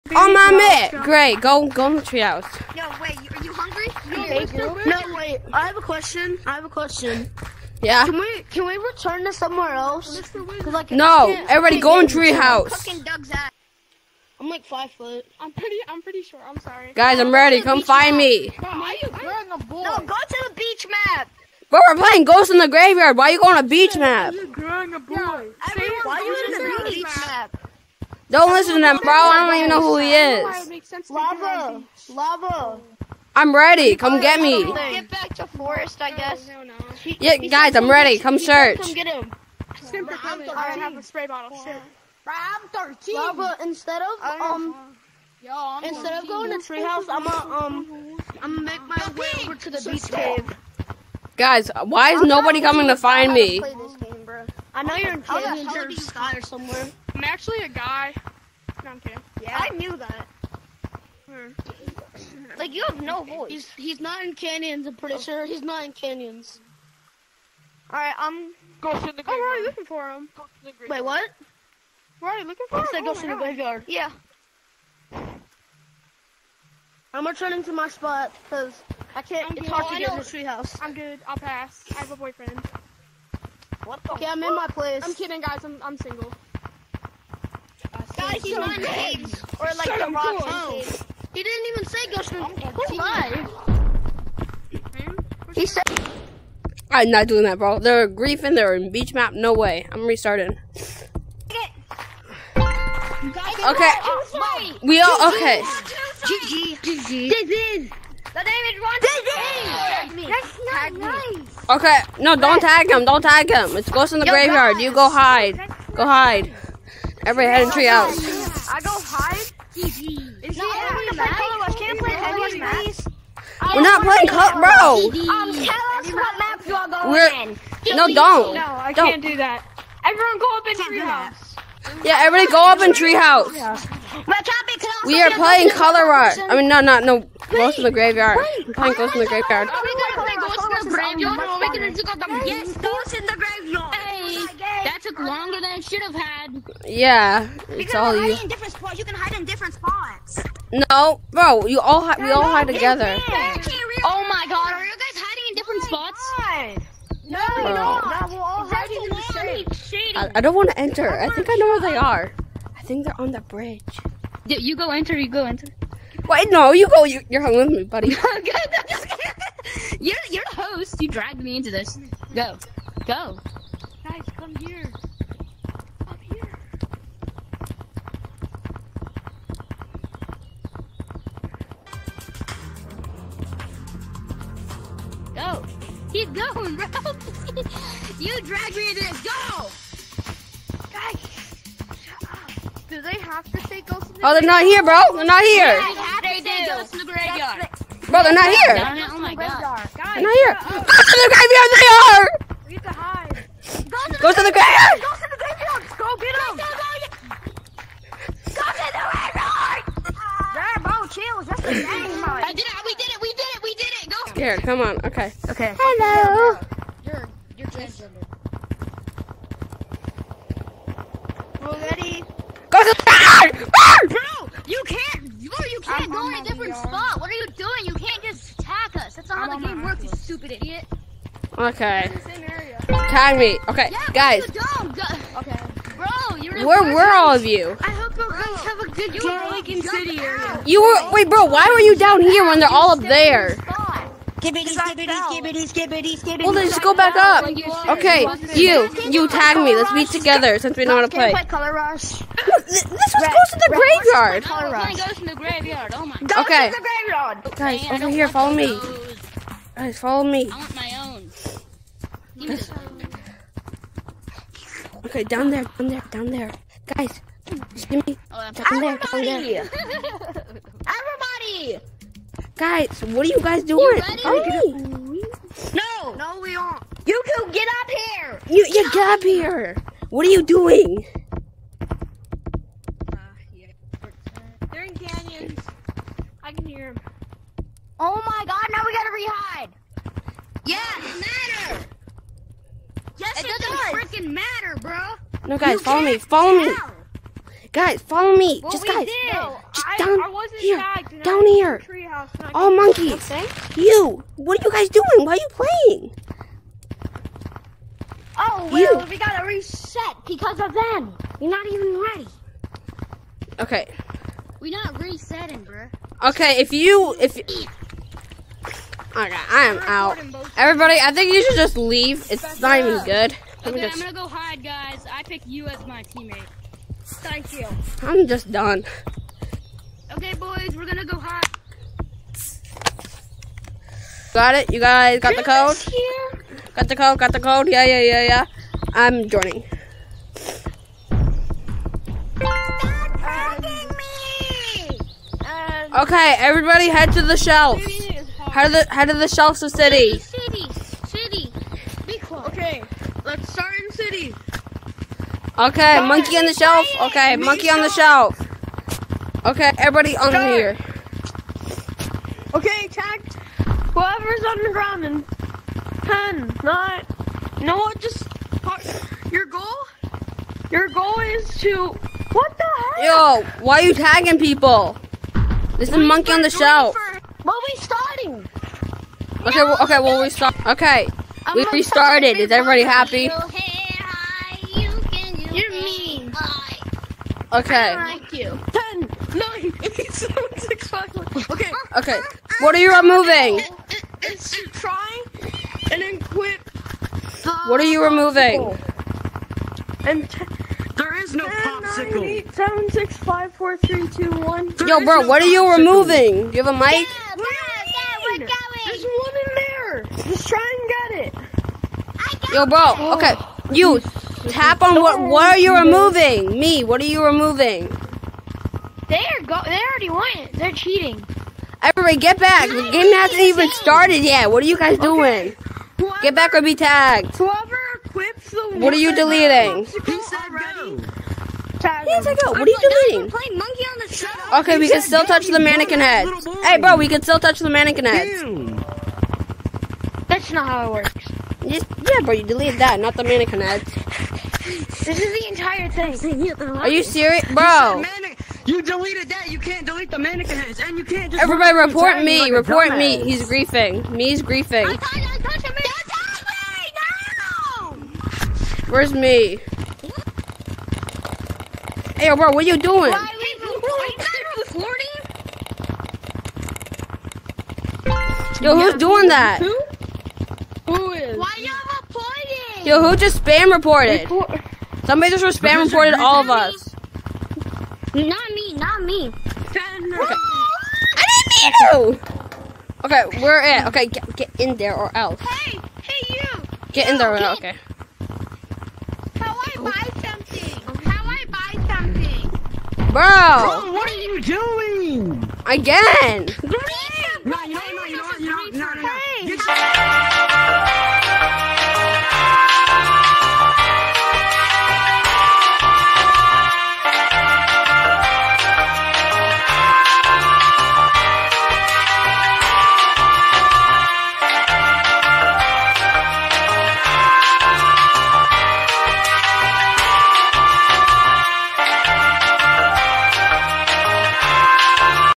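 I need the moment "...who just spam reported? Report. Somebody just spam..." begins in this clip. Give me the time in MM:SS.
07:52.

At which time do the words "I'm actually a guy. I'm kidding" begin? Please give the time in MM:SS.
00:57.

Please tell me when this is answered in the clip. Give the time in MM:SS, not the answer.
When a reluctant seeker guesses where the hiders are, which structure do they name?
02:43.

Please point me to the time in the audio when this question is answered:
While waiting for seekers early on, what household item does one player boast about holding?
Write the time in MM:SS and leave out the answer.
00:41.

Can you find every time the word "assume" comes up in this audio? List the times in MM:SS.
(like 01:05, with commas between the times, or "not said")
not said.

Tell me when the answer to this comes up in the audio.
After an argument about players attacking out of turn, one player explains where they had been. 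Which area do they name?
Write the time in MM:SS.
03:59.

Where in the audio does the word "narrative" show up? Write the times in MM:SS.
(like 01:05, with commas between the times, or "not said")
not said.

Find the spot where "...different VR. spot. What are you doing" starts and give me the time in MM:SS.
03:46.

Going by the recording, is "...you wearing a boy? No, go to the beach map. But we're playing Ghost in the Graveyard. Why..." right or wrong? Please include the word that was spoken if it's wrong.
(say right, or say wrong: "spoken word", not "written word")
right.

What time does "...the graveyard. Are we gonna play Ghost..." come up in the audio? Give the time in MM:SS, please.
02:19.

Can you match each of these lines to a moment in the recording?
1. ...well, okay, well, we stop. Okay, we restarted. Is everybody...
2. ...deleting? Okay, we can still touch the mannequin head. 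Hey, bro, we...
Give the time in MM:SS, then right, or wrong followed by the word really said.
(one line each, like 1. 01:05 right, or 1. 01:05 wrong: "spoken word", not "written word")
1. 06:19 right
2. 07:12 right.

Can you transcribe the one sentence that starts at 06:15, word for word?
This is monkey on the shelf.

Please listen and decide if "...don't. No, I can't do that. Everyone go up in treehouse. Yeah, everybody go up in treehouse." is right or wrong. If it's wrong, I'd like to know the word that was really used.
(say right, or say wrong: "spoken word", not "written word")
right.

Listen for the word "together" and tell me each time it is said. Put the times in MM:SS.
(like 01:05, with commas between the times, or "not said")
02:32, 04:10.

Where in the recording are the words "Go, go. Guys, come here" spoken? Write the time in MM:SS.
02:52.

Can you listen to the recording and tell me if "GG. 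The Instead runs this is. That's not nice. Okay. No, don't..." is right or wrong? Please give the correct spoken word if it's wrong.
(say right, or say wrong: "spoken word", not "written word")
wrong: "David", not "Instead".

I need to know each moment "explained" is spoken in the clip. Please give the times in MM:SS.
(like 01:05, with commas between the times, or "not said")
not said.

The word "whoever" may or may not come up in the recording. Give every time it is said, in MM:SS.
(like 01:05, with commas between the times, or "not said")
06:03, 07:07.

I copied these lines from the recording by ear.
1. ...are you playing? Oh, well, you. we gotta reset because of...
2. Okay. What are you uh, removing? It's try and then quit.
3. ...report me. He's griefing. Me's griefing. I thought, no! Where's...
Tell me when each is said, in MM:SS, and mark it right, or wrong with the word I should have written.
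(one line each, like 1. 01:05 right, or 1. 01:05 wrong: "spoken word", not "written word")
1. 05:05 right
2. 06:31 right
3. 07:32 right.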